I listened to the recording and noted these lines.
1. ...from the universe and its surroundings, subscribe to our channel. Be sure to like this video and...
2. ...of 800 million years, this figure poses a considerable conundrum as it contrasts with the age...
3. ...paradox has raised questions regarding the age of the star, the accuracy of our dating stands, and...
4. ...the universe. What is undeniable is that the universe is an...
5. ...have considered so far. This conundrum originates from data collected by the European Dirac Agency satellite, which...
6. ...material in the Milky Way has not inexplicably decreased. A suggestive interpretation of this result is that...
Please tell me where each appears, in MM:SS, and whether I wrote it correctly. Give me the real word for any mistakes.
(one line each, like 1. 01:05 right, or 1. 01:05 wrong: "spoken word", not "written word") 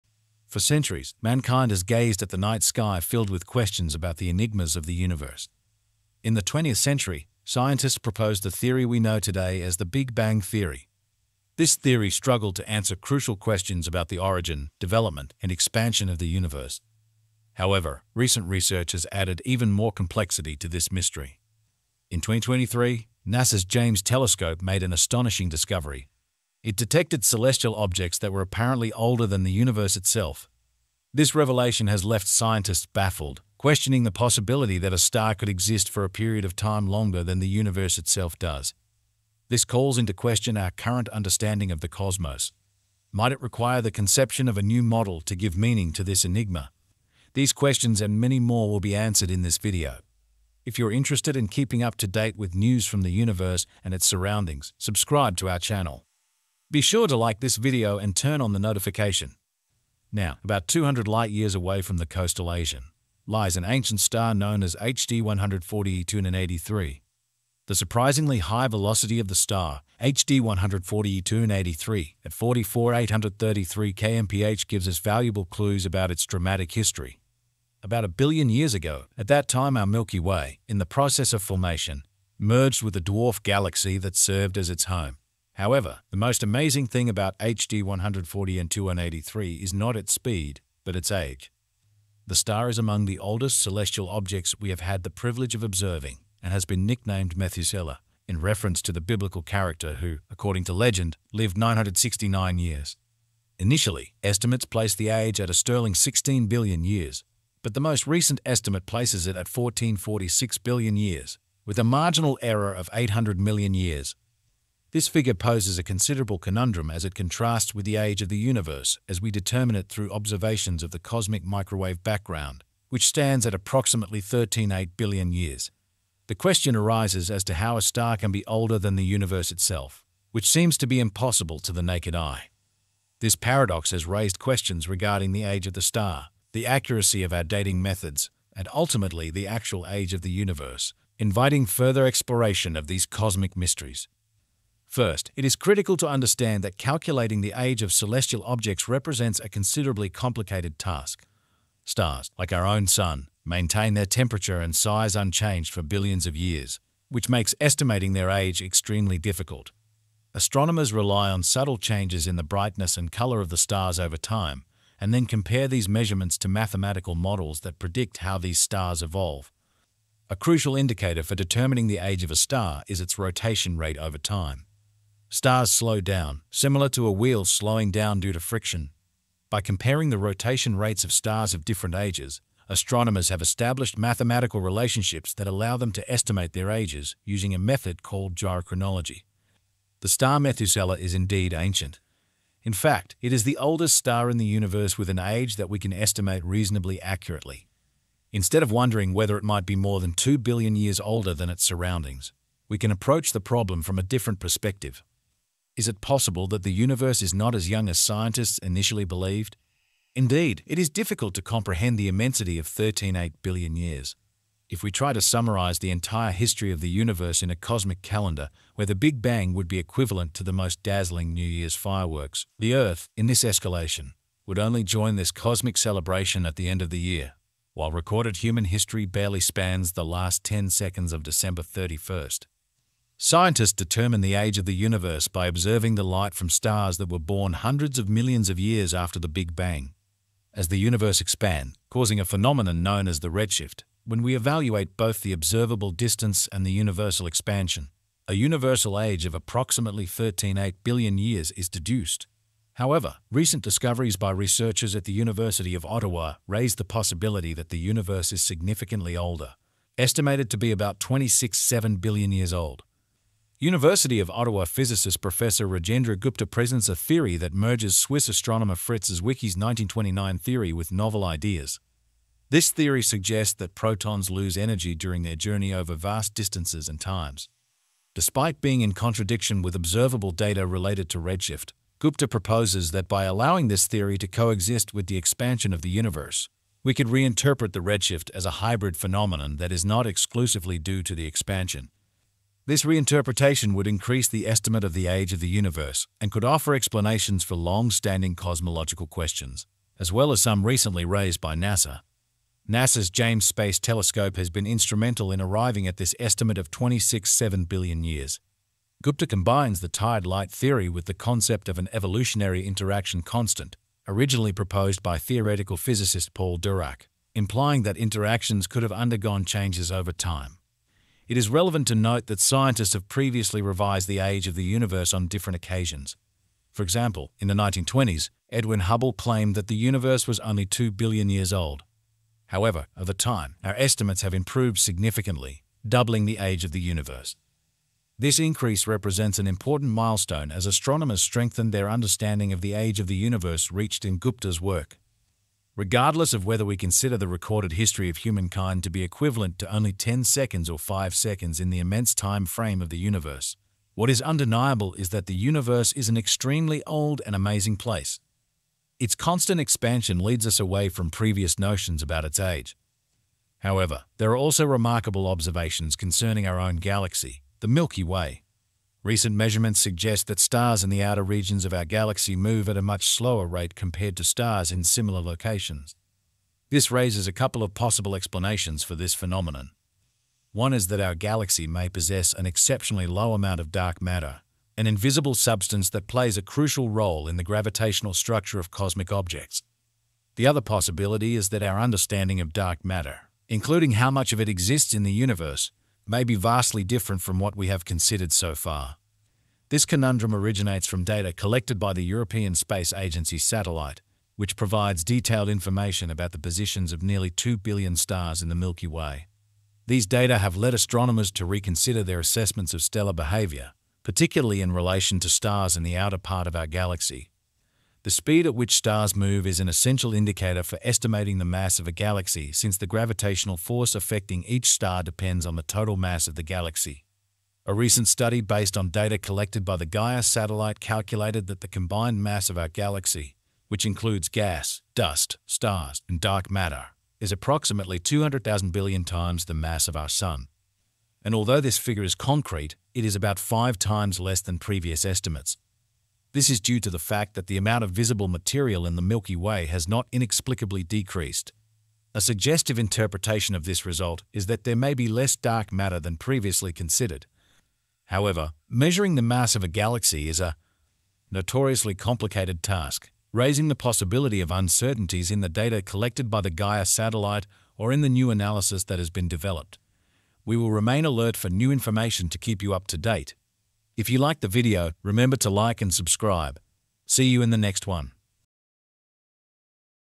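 1. 00:52 right
2. 01:52 right
3. 02:13 wrong: "methods", not "stands"
4. 05:52 right
5. 06:37 wrong: "Space", not "Dirac"
6. 07:28 right.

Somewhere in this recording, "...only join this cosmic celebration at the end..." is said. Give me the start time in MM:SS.
03:44.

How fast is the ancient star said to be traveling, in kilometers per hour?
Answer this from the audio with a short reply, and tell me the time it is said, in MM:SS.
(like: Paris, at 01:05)
44,833 km/h, at 01:12.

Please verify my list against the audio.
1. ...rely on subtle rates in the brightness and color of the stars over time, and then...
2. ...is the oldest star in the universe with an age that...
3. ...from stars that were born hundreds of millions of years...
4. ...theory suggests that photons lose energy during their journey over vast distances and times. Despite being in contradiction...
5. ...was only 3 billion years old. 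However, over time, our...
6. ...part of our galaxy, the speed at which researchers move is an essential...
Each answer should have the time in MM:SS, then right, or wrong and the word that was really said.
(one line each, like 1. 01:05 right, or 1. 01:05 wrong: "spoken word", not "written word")
1. 02:40 wrong: "changes", not "rates"
2. 03:13 right
3. 03:56 right
4. 04:32 right
5. 05:30 wrong: "2", not "3"
6. 06:56 wrong: "stars", not "researchers".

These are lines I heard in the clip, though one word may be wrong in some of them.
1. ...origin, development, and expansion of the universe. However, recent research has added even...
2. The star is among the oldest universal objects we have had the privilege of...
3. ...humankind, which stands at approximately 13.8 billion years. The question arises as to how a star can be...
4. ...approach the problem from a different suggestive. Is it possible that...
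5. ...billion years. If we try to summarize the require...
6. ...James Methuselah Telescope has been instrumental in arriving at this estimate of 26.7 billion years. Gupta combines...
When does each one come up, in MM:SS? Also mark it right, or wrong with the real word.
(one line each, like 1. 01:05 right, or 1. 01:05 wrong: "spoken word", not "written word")
1. 00:14 right
2. 01:32 wrong: "celestial", not "universal"
3. 02:02 wrong: "background", not "humankind"
4. 03:22 wrong: "perspective", not "suggestive"
5. 03:33 wrong: "entire", not "require"
6. 05:03 wrong: "Space", not "Methuselah".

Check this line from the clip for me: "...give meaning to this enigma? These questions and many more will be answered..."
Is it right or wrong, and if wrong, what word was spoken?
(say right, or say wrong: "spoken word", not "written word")
right.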